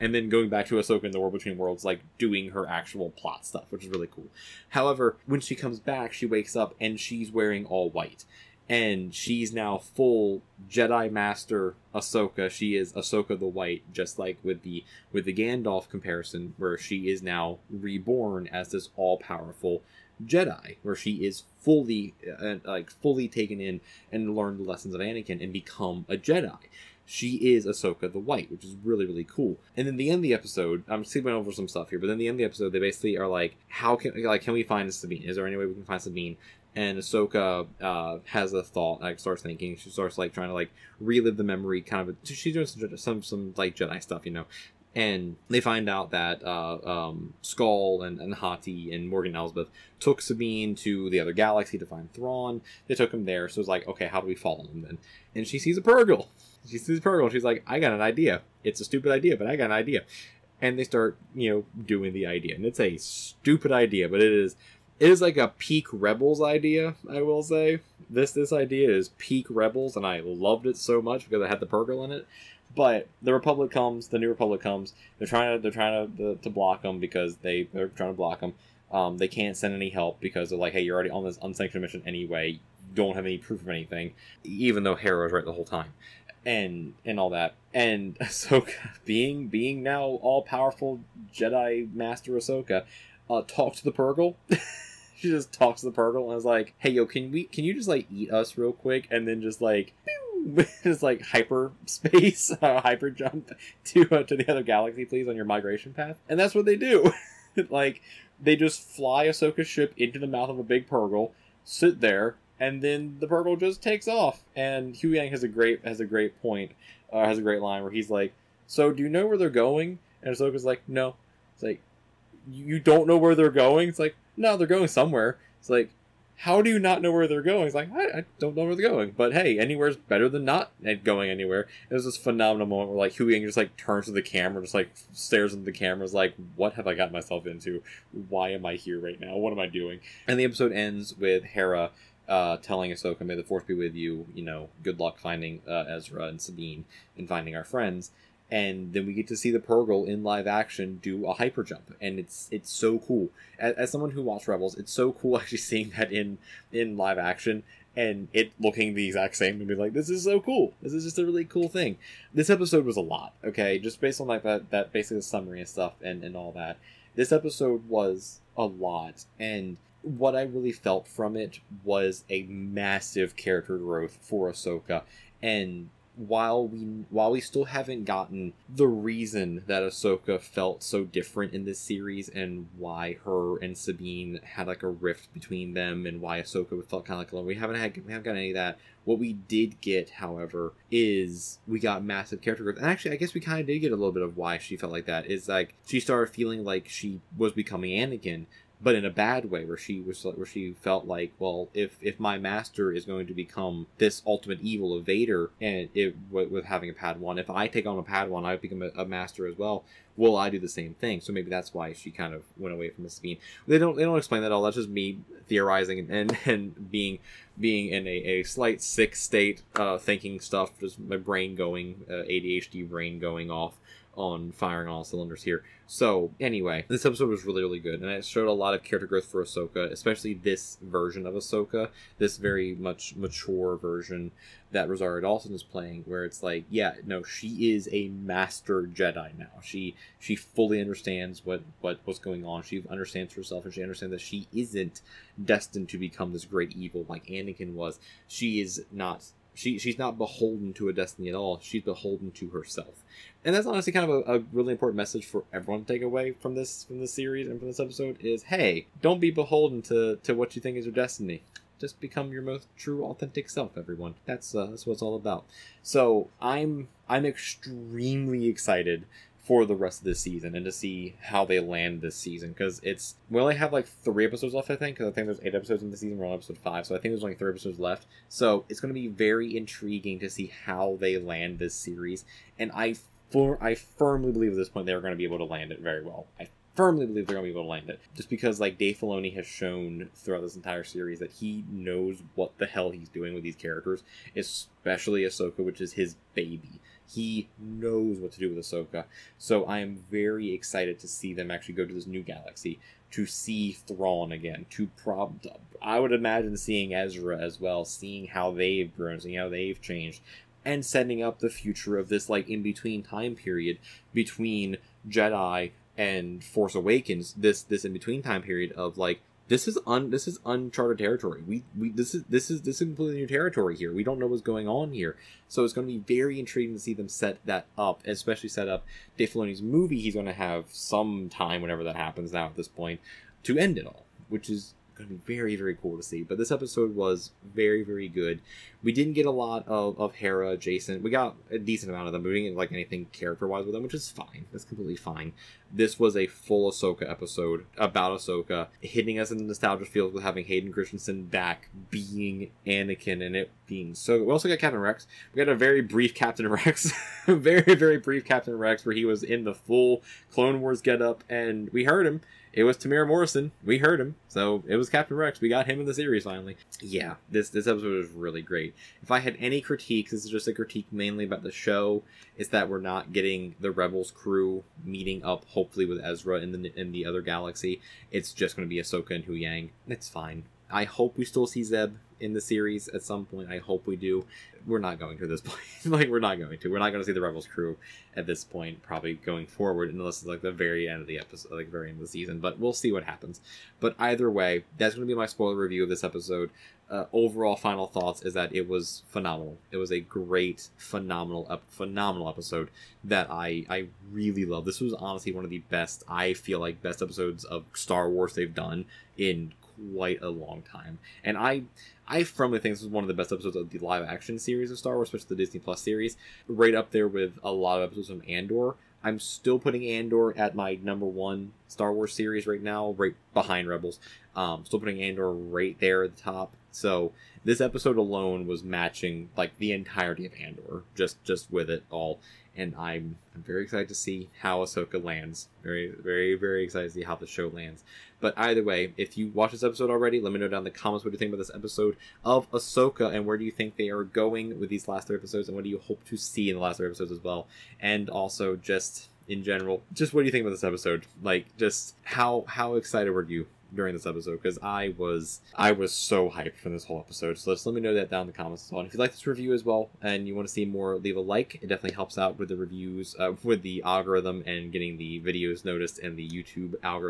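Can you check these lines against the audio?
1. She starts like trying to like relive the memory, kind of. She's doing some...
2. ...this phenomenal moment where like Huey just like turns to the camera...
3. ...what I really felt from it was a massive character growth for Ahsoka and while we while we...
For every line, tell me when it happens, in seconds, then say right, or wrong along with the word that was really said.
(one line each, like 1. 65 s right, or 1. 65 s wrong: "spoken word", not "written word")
1. 39 s right
2. 132 s right
3. 170 s right.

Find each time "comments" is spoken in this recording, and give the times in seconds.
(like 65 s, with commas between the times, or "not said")
440 s, 458 s.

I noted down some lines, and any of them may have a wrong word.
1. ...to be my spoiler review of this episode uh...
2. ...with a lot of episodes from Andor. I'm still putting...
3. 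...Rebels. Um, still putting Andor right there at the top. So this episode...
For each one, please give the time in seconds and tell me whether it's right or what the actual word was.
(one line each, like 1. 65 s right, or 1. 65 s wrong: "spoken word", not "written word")
1. 395 s right
2. 417 s right
3. 423 s right.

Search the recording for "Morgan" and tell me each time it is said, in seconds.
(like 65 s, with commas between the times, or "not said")
49 s.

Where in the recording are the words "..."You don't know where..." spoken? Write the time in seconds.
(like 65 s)
122 s.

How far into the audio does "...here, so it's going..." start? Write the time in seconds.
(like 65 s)
324 s.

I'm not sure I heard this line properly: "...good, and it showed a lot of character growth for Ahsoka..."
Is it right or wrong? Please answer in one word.
right.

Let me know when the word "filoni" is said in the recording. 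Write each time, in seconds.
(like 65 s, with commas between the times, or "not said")
288 s, 329 s.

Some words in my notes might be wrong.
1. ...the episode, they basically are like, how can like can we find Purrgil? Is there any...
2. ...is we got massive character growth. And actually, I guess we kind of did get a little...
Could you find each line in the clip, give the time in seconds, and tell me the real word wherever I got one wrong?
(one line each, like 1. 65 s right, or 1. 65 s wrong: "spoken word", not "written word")
1. 32 s wrong: "Sabine", not "Purrgil"
2. 190 s right.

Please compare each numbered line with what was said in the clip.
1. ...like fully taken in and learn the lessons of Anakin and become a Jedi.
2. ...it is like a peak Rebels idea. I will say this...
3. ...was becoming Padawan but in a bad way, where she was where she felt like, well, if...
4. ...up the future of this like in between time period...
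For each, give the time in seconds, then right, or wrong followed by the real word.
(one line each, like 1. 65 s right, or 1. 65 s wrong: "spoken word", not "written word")
1. 22 s right
2. 64 s right
3. 197 s wrong: "Anakin", not "Padawan"
4. 311 s right.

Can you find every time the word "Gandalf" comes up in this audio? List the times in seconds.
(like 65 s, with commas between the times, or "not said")
15 s.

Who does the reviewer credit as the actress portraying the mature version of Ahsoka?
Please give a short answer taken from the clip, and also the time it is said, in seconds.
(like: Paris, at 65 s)
Rosario Dawson, at 234 s.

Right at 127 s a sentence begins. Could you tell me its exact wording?
It's like, I, I, don't know where they're going.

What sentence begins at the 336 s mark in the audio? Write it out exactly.
But this episode was very very good.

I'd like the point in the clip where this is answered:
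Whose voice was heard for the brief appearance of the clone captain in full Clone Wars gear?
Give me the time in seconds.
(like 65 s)
362 s.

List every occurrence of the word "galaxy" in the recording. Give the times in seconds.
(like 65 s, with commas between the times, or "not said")
51 s, 104 s, 302 s, 377 s.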